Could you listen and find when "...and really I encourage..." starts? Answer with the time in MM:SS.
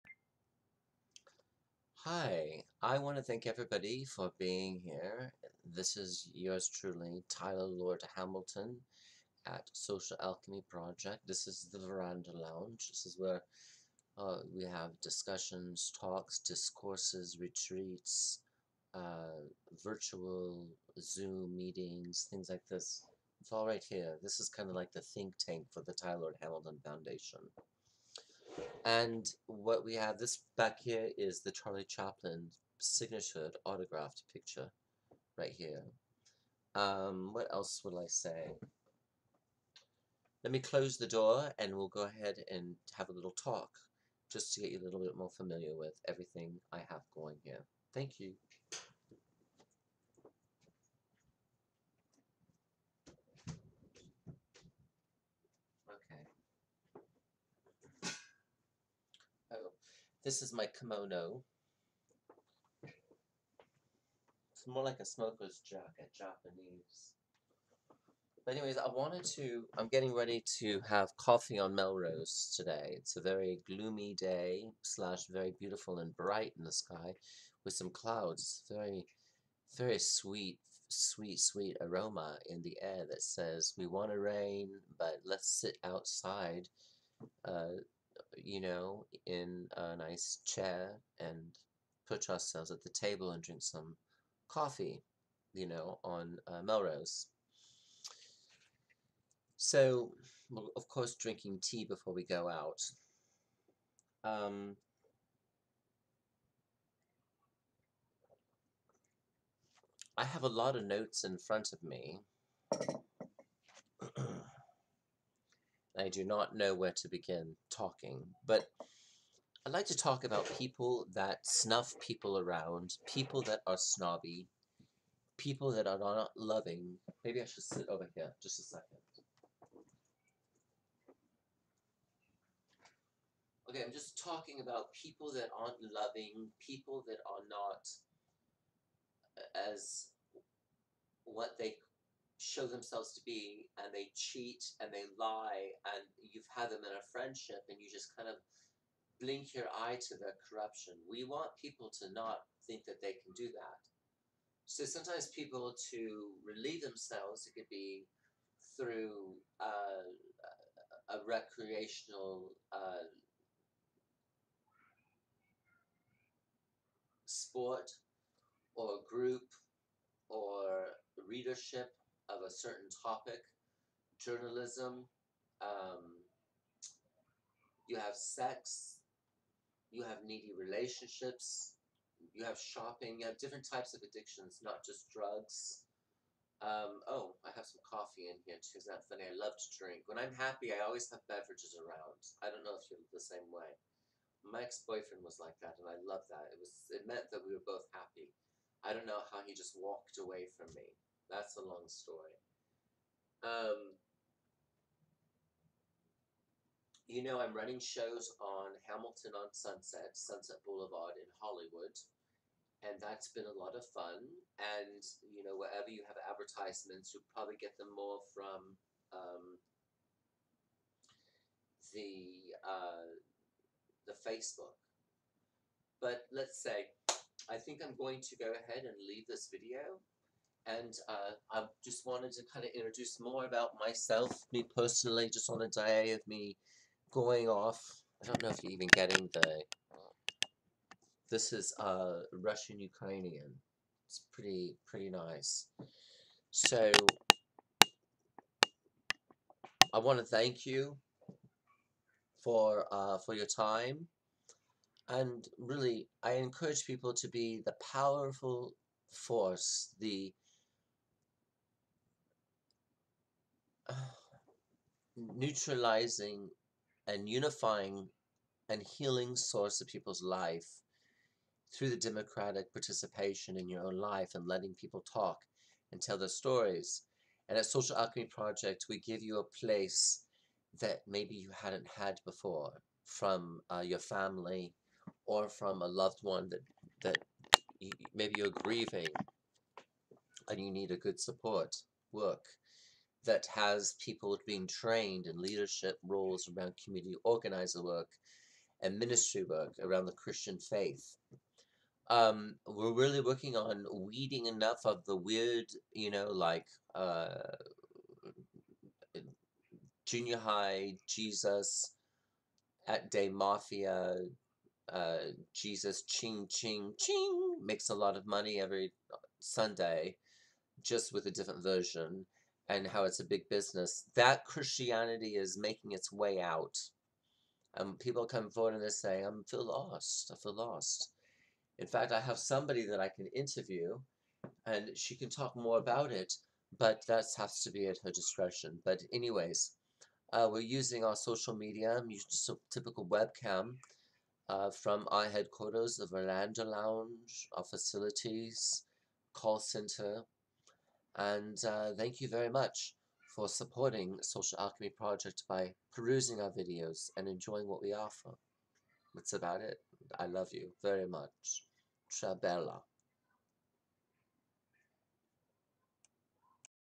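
04:15.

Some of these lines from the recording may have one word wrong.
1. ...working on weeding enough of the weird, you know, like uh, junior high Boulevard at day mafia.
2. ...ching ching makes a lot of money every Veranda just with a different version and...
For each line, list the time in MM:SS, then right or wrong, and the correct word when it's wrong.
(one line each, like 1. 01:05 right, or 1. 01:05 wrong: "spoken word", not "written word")
1. 05:03 wrong: "Jesus", not "Boulevard"
2. 05:16 wrong: "Sunday", not "Veranda".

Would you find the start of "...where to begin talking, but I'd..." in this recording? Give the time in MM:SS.
01:56.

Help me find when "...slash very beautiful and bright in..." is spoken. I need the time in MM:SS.
01:14.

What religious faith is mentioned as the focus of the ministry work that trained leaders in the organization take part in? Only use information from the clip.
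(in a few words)
Christian.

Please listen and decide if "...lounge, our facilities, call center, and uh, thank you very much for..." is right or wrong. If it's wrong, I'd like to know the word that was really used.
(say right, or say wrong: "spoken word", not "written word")
right.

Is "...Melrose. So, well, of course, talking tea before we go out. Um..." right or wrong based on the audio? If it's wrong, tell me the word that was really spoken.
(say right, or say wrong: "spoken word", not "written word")
wrong: "drinking", not "talking".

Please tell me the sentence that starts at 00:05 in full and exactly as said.
This is yours truly, Tyler Lord Hamilton at Social Alchemy Project.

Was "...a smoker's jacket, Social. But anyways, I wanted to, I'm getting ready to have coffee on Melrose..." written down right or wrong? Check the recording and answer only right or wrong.
wrong.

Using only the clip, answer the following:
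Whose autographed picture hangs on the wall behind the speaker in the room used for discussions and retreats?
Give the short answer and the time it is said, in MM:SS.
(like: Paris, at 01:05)
Charlie Chaplin, at 00:31.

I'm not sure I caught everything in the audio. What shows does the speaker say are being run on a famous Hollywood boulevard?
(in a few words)
Hamilton on Sunset.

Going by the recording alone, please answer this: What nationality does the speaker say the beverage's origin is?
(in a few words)
Russian Ukrainian.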